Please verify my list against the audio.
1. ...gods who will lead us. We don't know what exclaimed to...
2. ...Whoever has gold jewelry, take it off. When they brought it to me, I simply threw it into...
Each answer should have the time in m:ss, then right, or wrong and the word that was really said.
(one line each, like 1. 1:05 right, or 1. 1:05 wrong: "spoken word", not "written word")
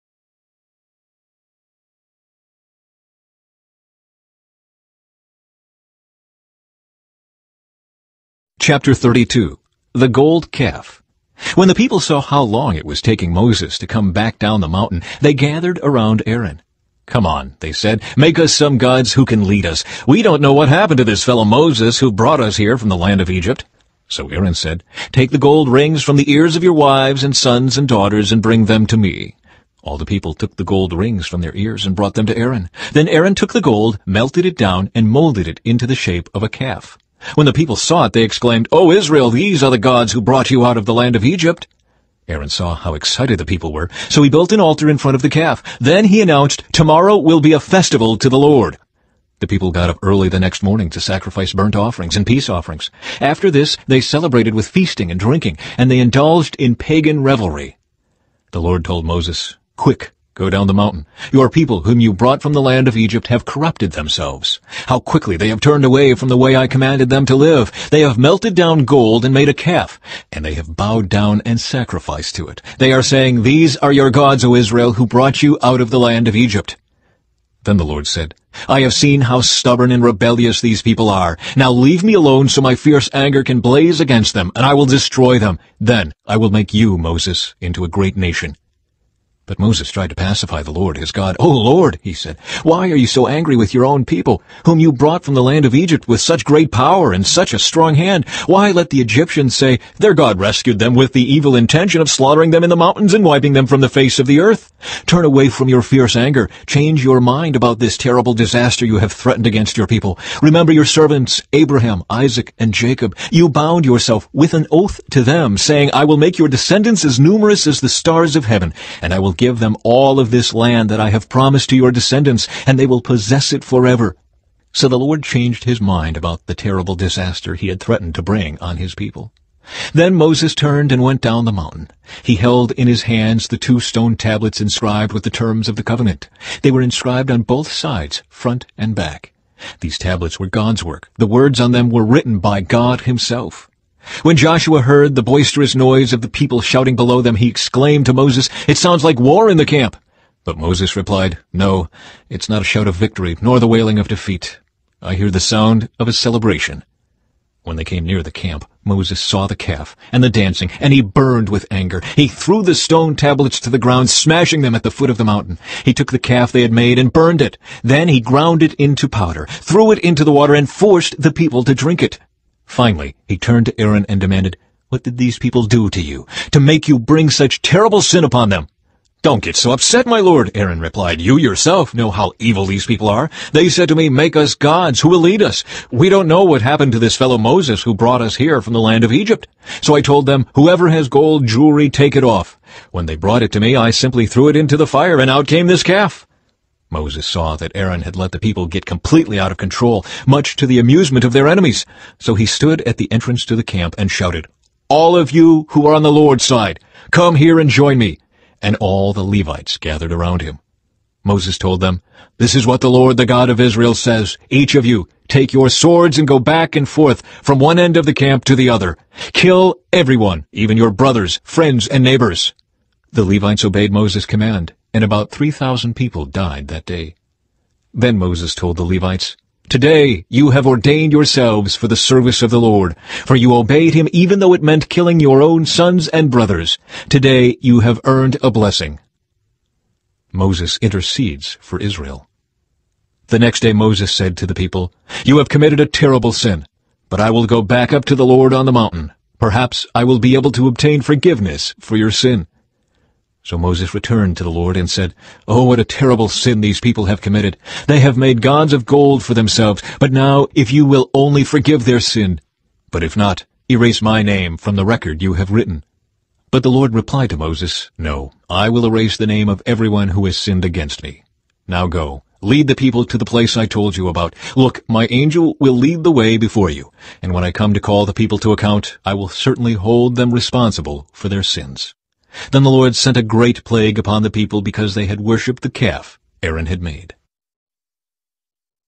1. 3:04 wrong: "happened", not "exclaimed"
2. 3:10 right.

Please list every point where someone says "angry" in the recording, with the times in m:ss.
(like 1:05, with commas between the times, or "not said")
1:33.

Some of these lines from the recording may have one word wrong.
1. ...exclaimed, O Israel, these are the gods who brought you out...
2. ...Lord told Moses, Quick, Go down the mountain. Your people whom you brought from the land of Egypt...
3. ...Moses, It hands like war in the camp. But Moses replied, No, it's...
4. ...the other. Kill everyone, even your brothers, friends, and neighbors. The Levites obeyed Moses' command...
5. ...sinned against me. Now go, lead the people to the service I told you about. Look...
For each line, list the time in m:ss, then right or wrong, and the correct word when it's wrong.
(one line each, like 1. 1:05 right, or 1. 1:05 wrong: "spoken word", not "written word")
1. 0:38 right
2. 0:58 right
3. 2:28 wrong: "sounds", not "hands"
4. 3:38 right
5. 4:30 wrong: "place", not "service".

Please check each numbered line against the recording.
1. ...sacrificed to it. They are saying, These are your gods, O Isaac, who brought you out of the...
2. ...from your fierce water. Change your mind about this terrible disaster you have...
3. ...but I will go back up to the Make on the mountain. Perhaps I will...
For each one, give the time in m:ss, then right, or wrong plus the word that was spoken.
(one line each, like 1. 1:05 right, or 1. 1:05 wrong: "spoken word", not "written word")
1. 1:11 wrong: "Israel", not "Isaac"
2. 1:45 wrong: "anger", not "water"
3. 4:07 wrong: "Lord", not "Make".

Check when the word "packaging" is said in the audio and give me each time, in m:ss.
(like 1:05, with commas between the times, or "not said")
not said.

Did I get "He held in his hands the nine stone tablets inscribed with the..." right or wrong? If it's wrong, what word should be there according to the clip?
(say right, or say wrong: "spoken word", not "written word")
wrong: "two", not "nine".